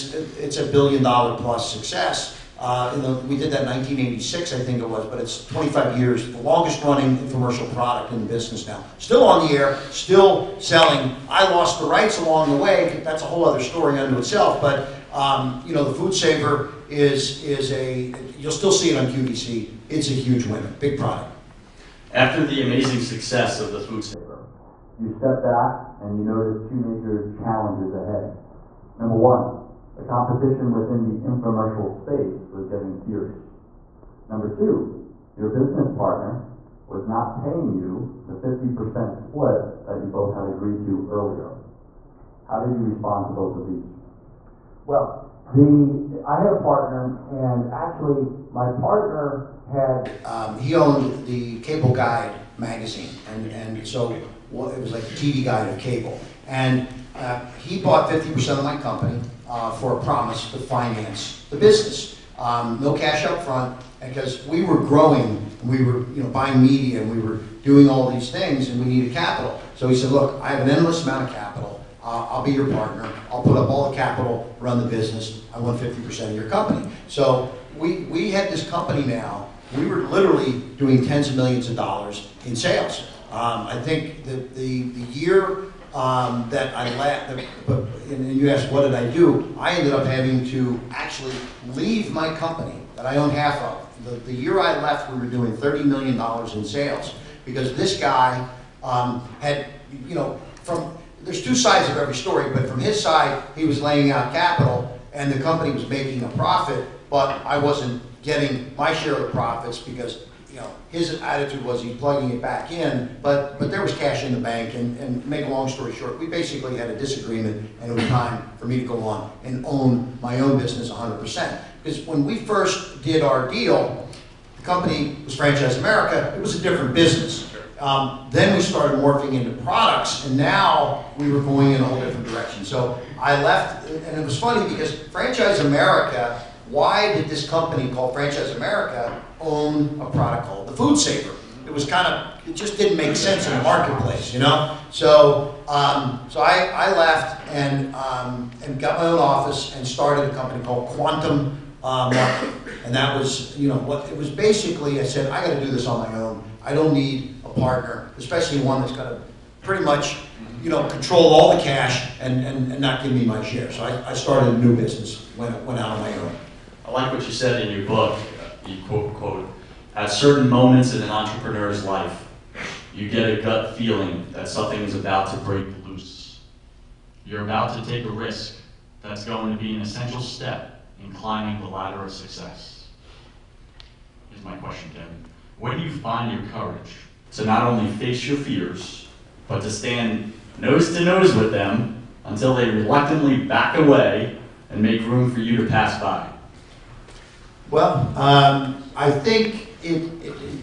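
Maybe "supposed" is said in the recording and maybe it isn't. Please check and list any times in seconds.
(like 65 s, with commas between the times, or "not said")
not said.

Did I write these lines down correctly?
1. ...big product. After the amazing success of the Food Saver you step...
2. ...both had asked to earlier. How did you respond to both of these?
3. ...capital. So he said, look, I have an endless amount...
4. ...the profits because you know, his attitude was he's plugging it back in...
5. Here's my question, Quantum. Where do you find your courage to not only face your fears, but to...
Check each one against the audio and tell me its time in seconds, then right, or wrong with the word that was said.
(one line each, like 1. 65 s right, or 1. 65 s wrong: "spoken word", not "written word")
1. 20 s right
2. 40 s wrong: "agreed", not "asked"
3. 69 s right
4. 109 s right
5. 184 s wrong: "Kevin", not "Quantum".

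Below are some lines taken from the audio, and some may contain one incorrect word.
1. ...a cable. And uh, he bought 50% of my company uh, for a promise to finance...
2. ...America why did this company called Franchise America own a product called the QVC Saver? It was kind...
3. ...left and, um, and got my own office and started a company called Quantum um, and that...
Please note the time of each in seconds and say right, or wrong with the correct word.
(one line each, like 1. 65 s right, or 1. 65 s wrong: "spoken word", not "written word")
1. 55 s right
2. 135 s wrong: "Food", not "QVC"
3. 146 s right.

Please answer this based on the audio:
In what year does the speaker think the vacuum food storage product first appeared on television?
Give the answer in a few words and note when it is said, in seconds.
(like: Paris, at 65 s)
1986, at 3 s.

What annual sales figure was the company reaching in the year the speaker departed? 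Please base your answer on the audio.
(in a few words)
$30 million.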